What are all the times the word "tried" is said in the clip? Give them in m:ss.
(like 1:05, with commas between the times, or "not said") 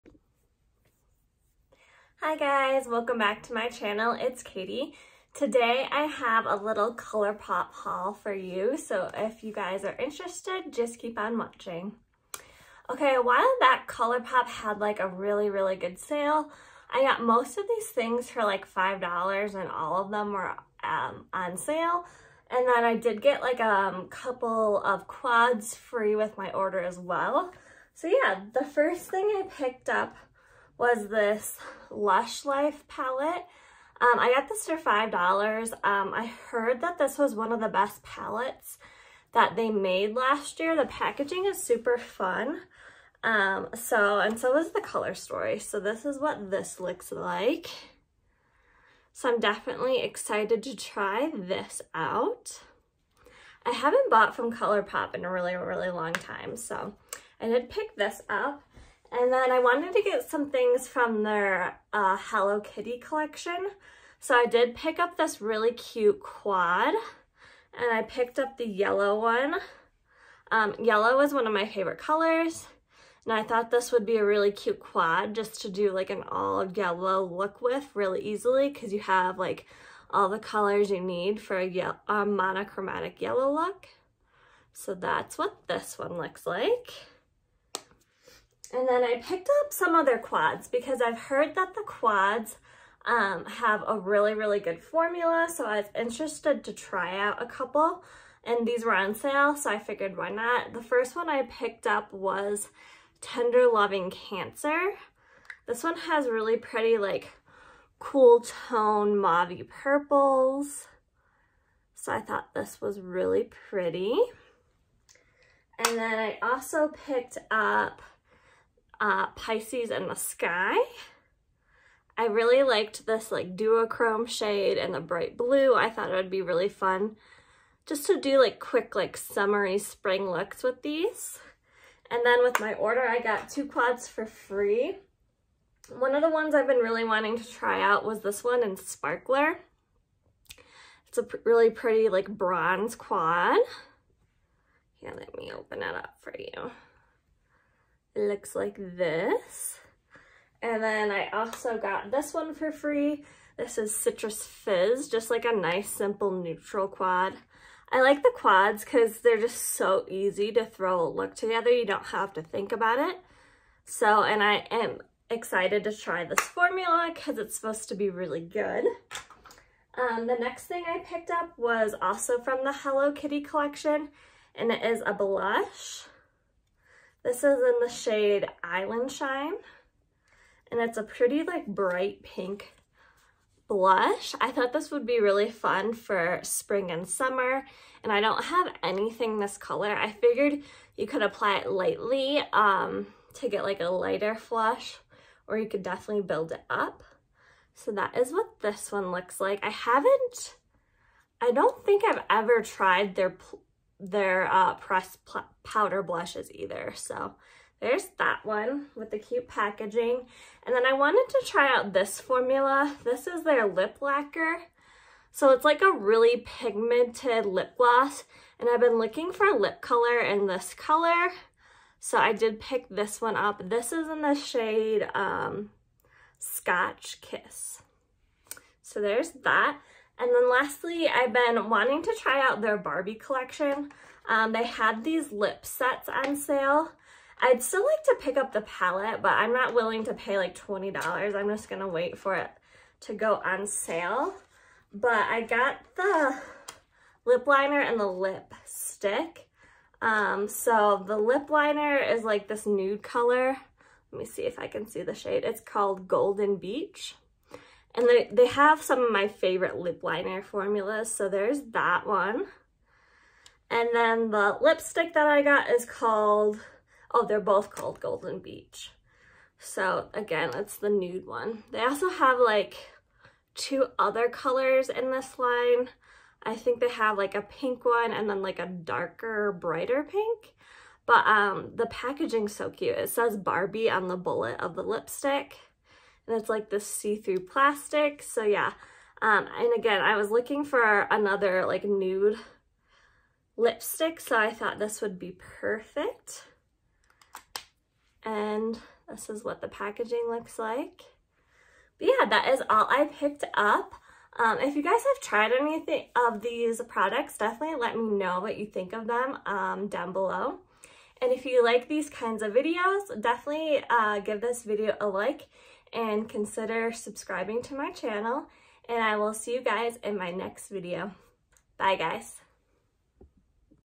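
3:22, 5:05.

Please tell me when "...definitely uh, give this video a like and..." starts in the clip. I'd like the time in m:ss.
5:13.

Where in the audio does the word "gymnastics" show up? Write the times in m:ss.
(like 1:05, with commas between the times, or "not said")
not said.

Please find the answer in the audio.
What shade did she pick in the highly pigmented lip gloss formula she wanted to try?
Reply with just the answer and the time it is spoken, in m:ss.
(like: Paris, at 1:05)
Scotch Kiss, at 3:46.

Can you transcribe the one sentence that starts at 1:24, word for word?
So that's what this one looks like.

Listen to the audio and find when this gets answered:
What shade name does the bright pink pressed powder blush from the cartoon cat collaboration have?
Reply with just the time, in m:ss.
2:58.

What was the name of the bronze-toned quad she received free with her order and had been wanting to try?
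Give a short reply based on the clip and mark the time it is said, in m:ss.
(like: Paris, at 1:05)
Sparkler, at 2:18.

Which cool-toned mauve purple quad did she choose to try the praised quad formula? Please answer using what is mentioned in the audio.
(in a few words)
Tender Loving Cancer.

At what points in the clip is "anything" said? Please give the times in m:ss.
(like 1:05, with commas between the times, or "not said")
3:08, 5:05.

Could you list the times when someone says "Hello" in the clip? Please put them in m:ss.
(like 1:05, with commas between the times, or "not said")
1:02, 2:52.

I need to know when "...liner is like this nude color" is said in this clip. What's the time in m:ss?
4:11.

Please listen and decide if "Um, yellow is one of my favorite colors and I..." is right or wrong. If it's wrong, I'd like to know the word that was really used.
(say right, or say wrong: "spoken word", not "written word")
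right.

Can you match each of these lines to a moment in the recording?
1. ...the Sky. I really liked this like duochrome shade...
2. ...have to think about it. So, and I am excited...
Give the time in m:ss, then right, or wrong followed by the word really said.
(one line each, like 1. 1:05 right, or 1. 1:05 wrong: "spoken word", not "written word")
1. 2:00 right
2. 2:42 right.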